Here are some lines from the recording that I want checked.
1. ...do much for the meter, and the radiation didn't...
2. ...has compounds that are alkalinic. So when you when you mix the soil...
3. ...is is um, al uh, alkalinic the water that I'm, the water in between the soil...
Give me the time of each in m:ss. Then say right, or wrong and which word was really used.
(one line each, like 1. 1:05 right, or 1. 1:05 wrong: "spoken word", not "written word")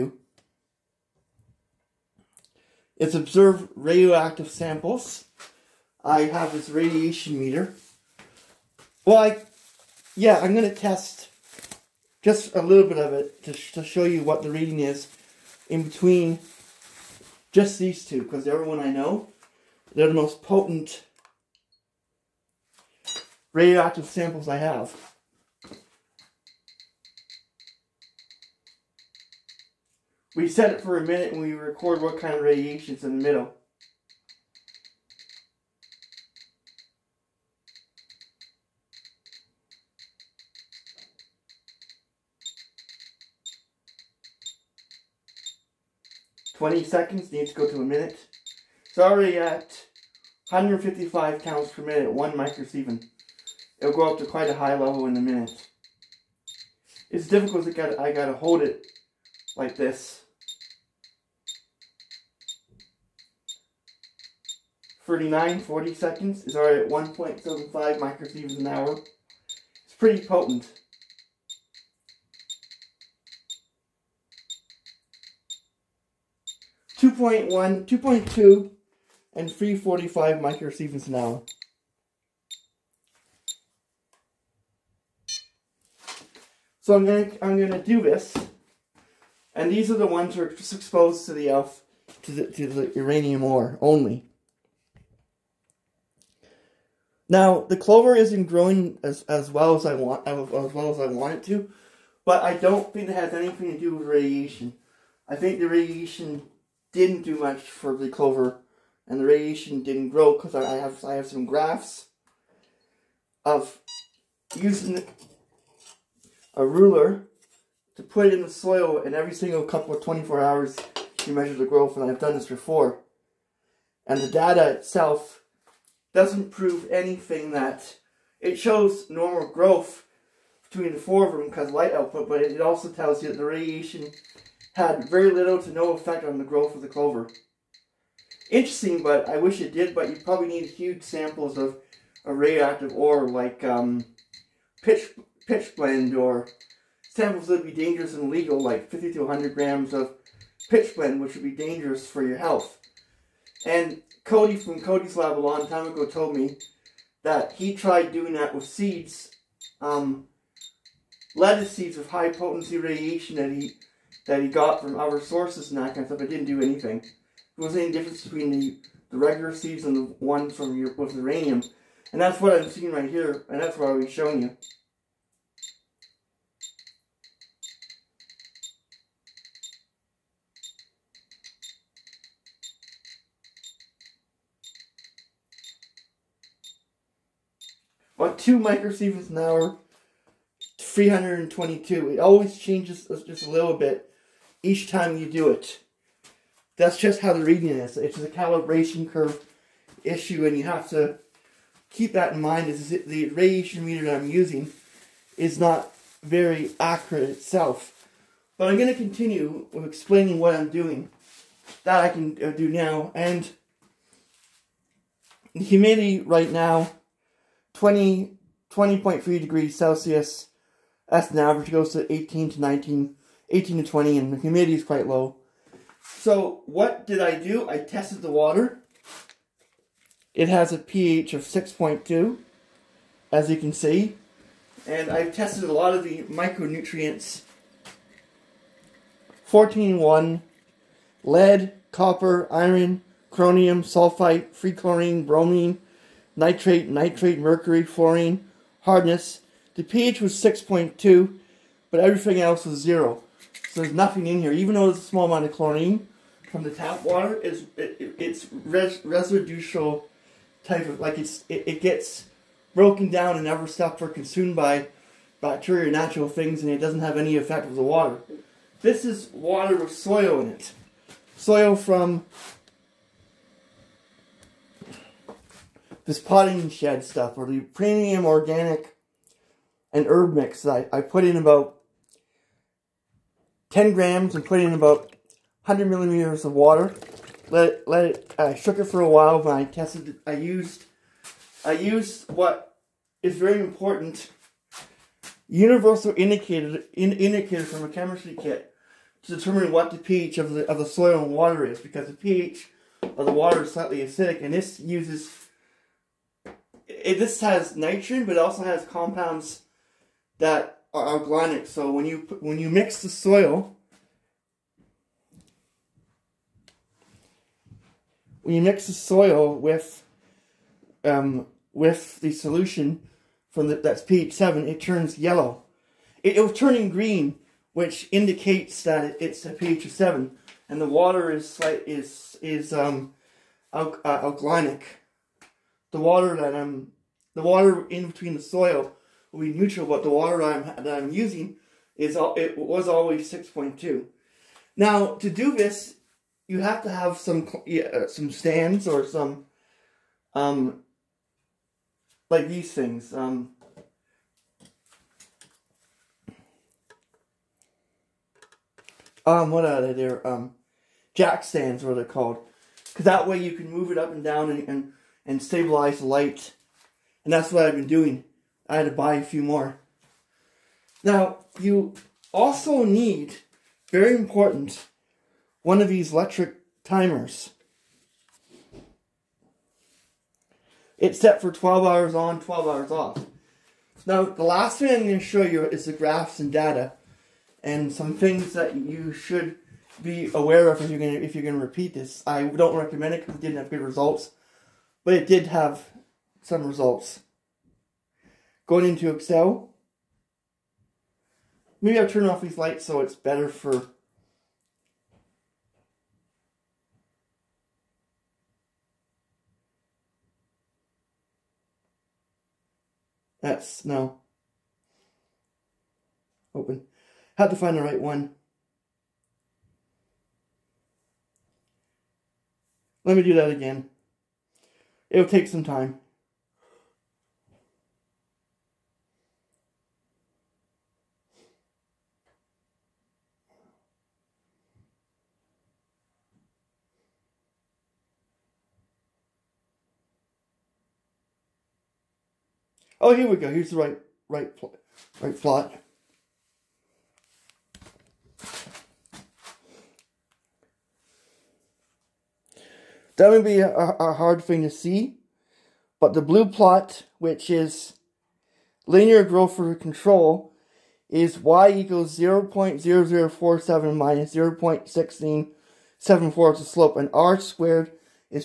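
1. 1:47 wrong: "clover", not "meter"
2. 5:08 right
3. 5:31 right.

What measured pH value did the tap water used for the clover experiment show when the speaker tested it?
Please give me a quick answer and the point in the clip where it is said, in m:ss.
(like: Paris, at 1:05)
6.2, at 3:50.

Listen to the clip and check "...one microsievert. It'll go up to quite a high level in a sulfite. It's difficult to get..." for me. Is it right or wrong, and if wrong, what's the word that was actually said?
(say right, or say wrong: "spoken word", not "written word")
wrong: "minute", not "sulfite".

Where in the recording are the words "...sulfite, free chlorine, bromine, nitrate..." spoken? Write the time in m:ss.
4:03.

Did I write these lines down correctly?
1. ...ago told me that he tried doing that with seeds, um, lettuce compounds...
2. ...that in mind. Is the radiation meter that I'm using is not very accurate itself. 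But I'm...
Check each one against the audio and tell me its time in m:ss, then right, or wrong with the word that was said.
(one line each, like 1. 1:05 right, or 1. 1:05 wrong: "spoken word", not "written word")
1. 2:35 wrong: "seeds", not "compounds"
2. 3:22 right.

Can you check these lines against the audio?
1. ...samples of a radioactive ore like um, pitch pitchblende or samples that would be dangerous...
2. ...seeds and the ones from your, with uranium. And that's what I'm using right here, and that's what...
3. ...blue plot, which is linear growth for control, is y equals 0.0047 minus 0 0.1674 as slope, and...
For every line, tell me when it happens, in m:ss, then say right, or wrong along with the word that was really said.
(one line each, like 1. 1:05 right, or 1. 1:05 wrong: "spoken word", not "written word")
1. 2:21 right
2. 2:49 wrong: "seeing", not "using"
3. 7:36 right.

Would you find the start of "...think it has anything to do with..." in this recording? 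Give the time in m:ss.
1:42.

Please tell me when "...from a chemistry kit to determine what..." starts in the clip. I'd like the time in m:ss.
4:57.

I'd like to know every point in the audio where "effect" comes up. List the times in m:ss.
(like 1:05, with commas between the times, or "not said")
2:15, 4:27.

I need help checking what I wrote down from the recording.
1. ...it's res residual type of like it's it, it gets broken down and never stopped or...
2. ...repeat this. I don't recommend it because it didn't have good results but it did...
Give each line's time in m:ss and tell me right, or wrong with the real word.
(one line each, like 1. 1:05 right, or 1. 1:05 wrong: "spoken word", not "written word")
1. 4:18 right
2. 6:31 right.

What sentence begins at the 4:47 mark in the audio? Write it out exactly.
Let it, let it, I uh, shook it for a while, but I tested, it.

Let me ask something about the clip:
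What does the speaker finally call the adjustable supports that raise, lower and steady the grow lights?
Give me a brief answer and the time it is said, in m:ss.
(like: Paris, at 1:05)
jack stands, at 6:01.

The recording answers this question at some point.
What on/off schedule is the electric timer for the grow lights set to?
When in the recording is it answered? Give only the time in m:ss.
6:21.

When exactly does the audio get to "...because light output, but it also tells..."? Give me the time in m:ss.
2:11.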